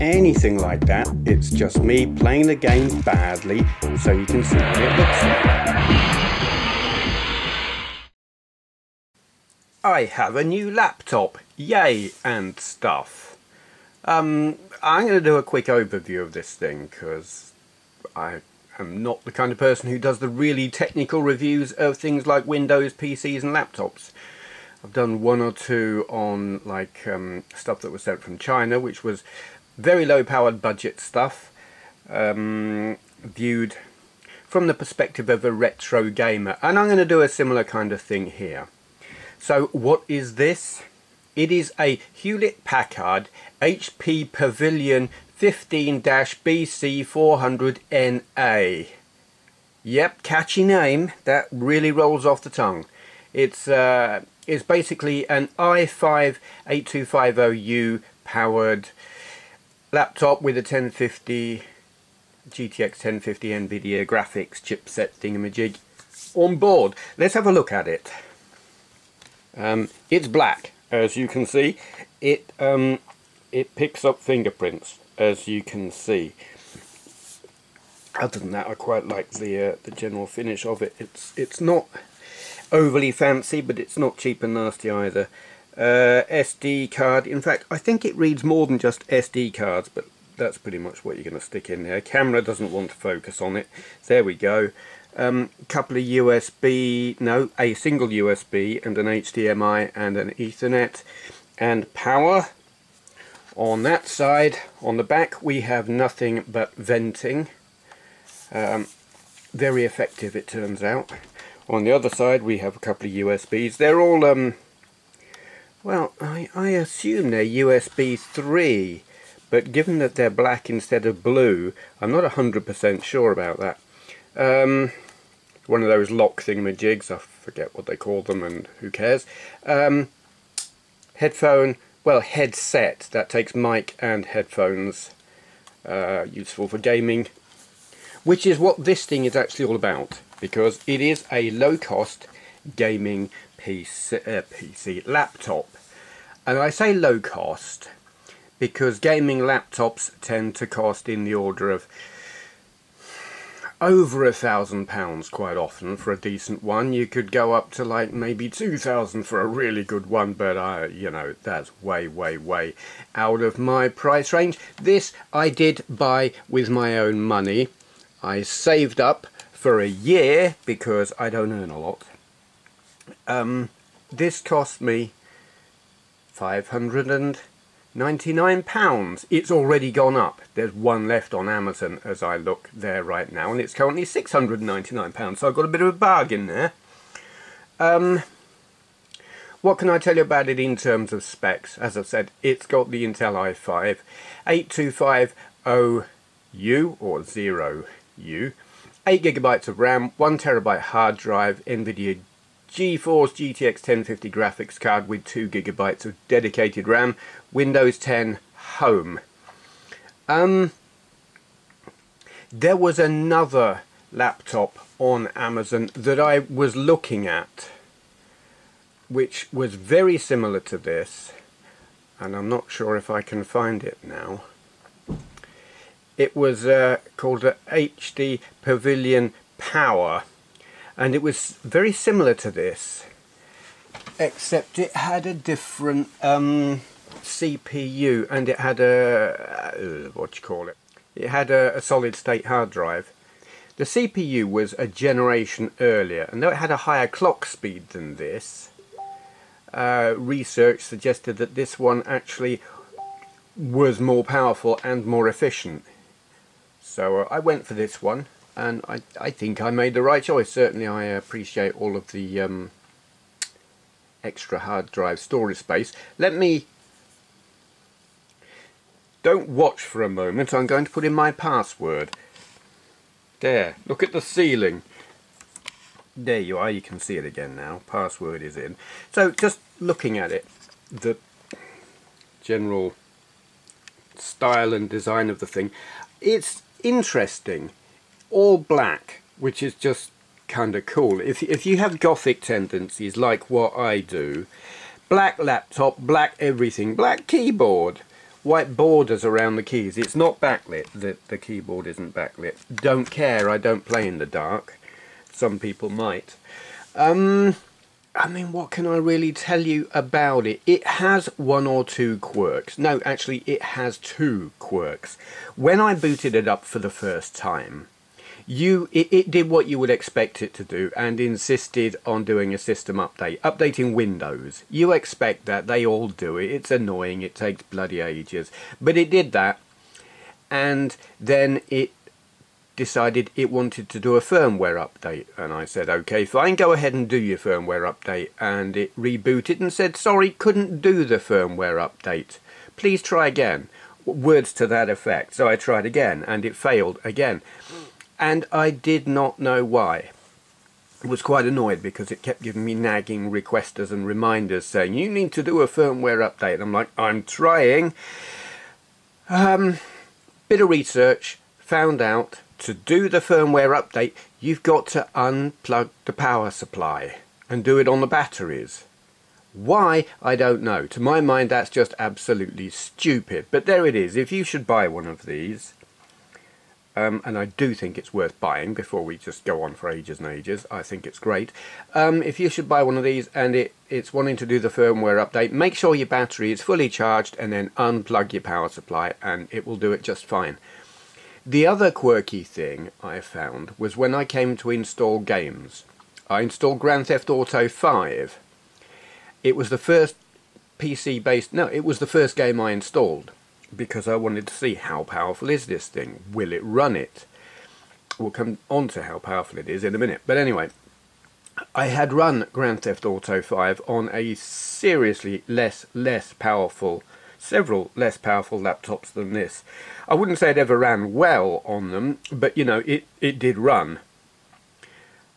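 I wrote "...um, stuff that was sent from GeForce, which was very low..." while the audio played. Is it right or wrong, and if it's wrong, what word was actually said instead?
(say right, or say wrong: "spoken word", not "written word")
wrong: "China", not "GeForce".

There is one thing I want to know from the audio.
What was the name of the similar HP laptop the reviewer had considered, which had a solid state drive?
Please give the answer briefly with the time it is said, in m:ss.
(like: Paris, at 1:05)
HP Pavilion Power, at 3:47.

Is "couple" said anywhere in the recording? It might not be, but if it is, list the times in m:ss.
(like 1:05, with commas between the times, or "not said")
1:35, 1:52.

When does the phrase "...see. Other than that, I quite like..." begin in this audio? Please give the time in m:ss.
1:15.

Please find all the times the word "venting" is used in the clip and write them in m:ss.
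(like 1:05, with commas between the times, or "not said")
1:46.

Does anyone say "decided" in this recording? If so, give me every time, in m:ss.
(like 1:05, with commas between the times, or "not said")
5:32.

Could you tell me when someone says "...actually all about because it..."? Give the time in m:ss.
2:19.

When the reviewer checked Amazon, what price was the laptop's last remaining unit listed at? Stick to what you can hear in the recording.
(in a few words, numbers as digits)
£699.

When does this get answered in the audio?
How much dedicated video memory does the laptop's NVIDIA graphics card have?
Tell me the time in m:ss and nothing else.
3:25.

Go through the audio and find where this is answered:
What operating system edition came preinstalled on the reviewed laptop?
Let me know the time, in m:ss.
3:27.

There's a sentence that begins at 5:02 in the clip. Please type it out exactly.
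Don't care, I don't play in the dark.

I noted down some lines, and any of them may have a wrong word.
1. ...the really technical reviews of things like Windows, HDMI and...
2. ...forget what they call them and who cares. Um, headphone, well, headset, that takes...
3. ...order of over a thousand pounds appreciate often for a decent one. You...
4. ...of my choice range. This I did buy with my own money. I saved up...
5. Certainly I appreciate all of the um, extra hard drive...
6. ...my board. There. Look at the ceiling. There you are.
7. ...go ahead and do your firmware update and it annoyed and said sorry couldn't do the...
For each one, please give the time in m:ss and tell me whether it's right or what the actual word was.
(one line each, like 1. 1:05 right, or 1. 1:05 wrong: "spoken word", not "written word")
1. 0:20 wrong: "PCs", not "HDMI"
2. 2:07 right
3. 2:31 wrong: "quite", not "appreciate"
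4. 2:43 wrong: "price", not "choice"
5. 4:20 right
6. 4:31 wrong: "password", not "board"
7. 5:36 wrong: "rebooted", not "annoyed".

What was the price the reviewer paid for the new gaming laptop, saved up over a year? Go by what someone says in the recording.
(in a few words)
£599.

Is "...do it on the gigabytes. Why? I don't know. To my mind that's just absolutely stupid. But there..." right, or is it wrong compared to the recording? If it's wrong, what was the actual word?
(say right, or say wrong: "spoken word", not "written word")
wrong: "batteries", not "gigabytes".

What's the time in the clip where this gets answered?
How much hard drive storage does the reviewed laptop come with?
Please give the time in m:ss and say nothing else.
3:20.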